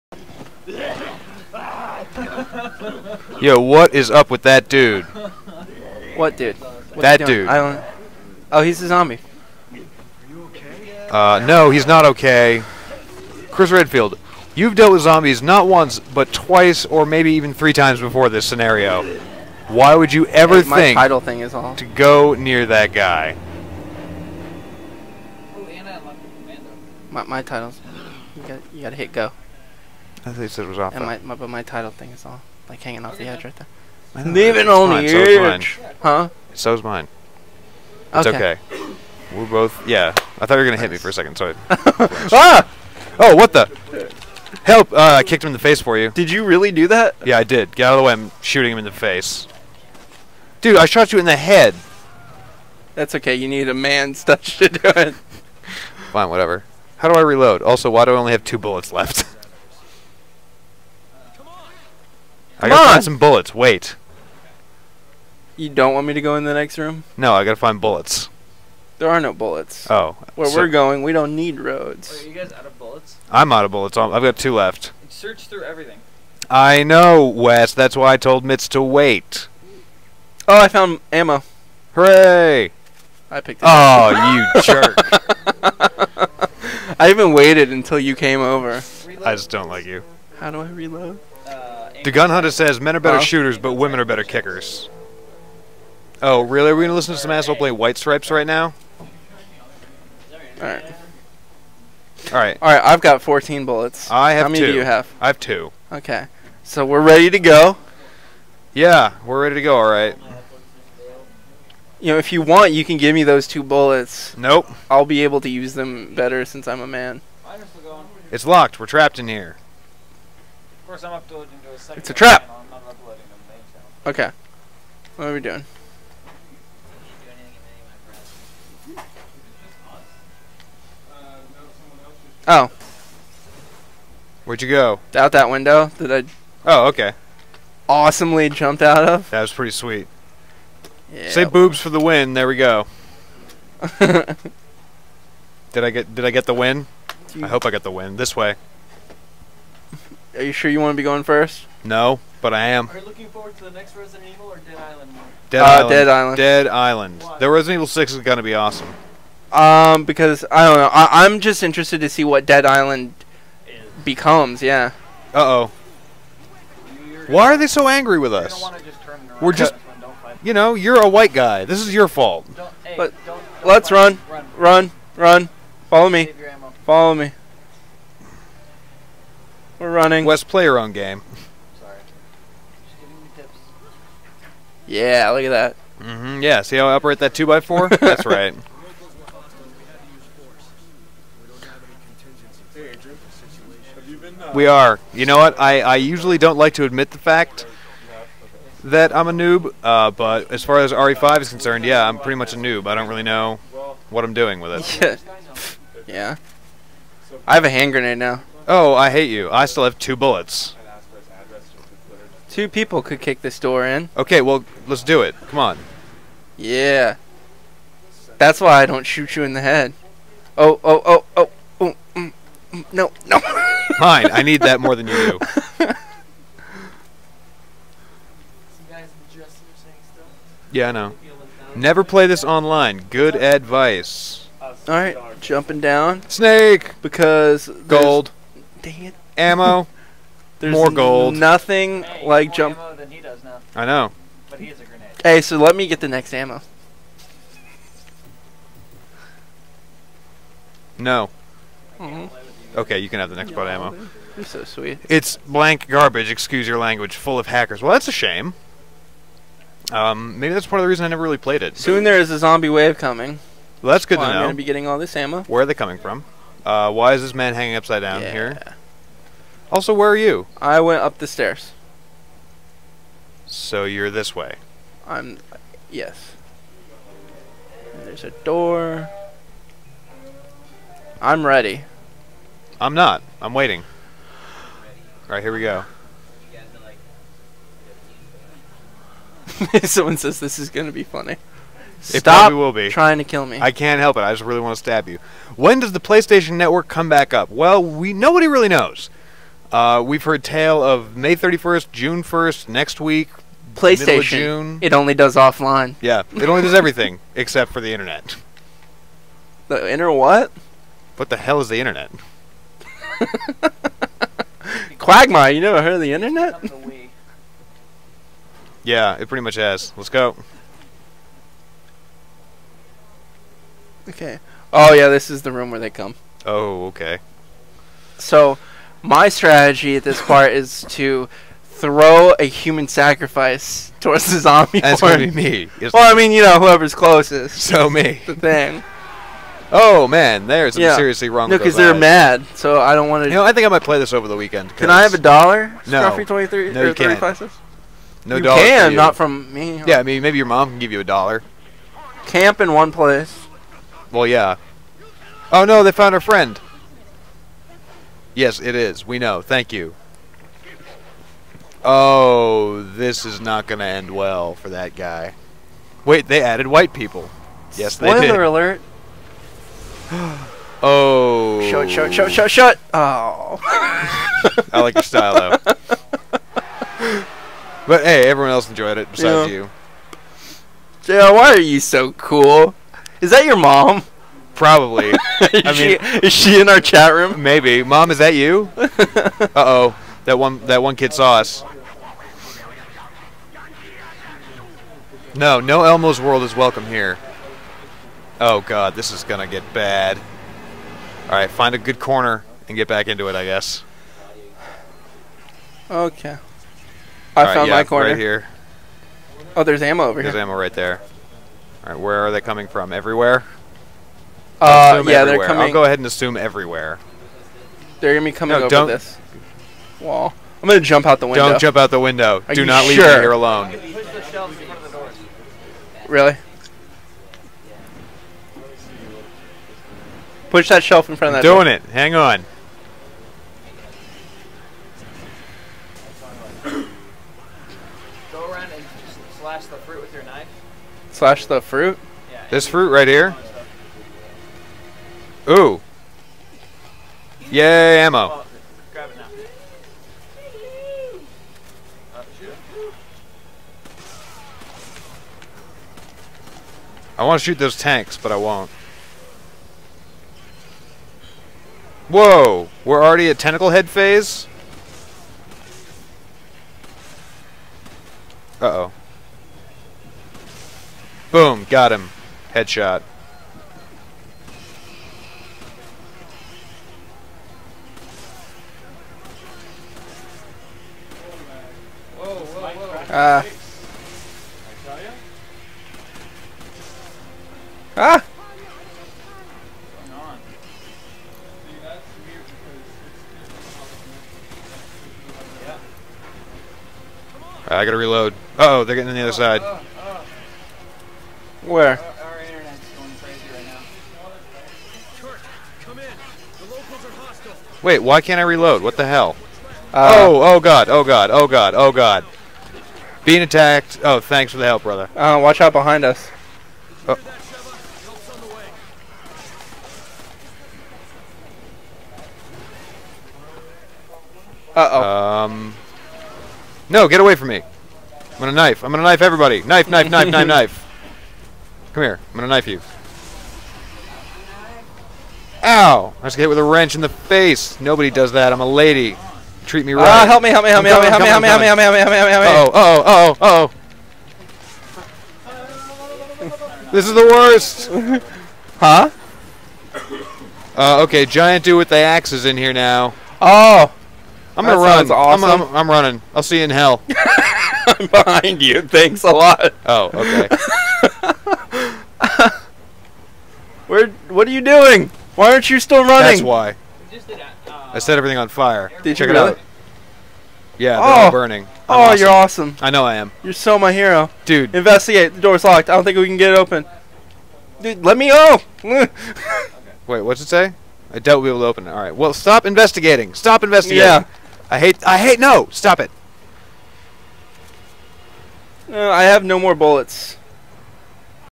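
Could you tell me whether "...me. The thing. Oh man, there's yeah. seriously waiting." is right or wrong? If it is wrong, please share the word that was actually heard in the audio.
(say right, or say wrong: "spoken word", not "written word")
wrong: "wrong", not "waiting".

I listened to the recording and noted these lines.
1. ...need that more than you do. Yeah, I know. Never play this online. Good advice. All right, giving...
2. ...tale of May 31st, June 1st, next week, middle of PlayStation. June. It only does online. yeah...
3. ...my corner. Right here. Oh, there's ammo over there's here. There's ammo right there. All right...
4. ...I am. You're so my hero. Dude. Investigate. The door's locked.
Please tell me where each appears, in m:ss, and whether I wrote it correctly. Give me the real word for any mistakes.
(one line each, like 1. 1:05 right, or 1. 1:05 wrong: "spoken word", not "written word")
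1. 3:44 wrong: "jumping", not "giving"
2. 5:00 wrong: "offline", not "online"
3. 6:47 right
4. 9:33 right.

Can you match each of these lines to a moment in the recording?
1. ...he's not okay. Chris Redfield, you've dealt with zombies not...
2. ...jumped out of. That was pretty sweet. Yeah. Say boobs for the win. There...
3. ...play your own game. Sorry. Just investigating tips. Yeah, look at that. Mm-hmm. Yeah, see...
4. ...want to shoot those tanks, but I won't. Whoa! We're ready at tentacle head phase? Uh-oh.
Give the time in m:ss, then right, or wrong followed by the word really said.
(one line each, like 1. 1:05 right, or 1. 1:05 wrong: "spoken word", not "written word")
1. 0:11 right
2. 2:18 right
3. 3:00 wrong: "giving", not "investigating"
4. 7:37 wrong: "already", not "ready".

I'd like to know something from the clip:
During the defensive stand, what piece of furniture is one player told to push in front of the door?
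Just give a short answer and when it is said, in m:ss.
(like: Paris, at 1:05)
Shelf, at 7:10.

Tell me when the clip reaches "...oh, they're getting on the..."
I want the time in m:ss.
8:18.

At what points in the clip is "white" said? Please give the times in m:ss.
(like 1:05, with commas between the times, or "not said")
1:37, 2:51, 6:06.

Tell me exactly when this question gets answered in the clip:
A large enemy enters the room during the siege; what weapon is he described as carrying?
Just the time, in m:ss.
9:11.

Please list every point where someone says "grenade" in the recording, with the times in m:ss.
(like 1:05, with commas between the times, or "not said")
3:27, 4:04.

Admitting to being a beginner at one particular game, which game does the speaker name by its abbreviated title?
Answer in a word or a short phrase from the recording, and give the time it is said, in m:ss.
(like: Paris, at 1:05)
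RE5, at 3:20.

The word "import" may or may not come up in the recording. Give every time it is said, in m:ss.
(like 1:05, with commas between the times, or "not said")
not said.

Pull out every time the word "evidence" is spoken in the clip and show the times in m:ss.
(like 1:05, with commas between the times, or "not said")
not said.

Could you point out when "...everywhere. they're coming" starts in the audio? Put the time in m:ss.
6:55.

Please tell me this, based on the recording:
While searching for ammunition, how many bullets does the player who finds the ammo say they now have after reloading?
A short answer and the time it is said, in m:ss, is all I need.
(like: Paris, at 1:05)
14, at 1:42.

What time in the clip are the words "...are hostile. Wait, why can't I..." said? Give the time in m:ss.
8:27.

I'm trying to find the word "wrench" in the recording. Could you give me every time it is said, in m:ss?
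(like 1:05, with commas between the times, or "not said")
8:56.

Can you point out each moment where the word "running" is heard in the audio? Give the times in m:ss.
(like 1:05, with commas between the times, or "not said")
2:59, 9:15, 9:26.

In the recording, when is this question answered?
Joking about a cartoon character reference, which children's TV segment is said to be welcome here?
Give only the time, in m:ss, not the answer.
6:35.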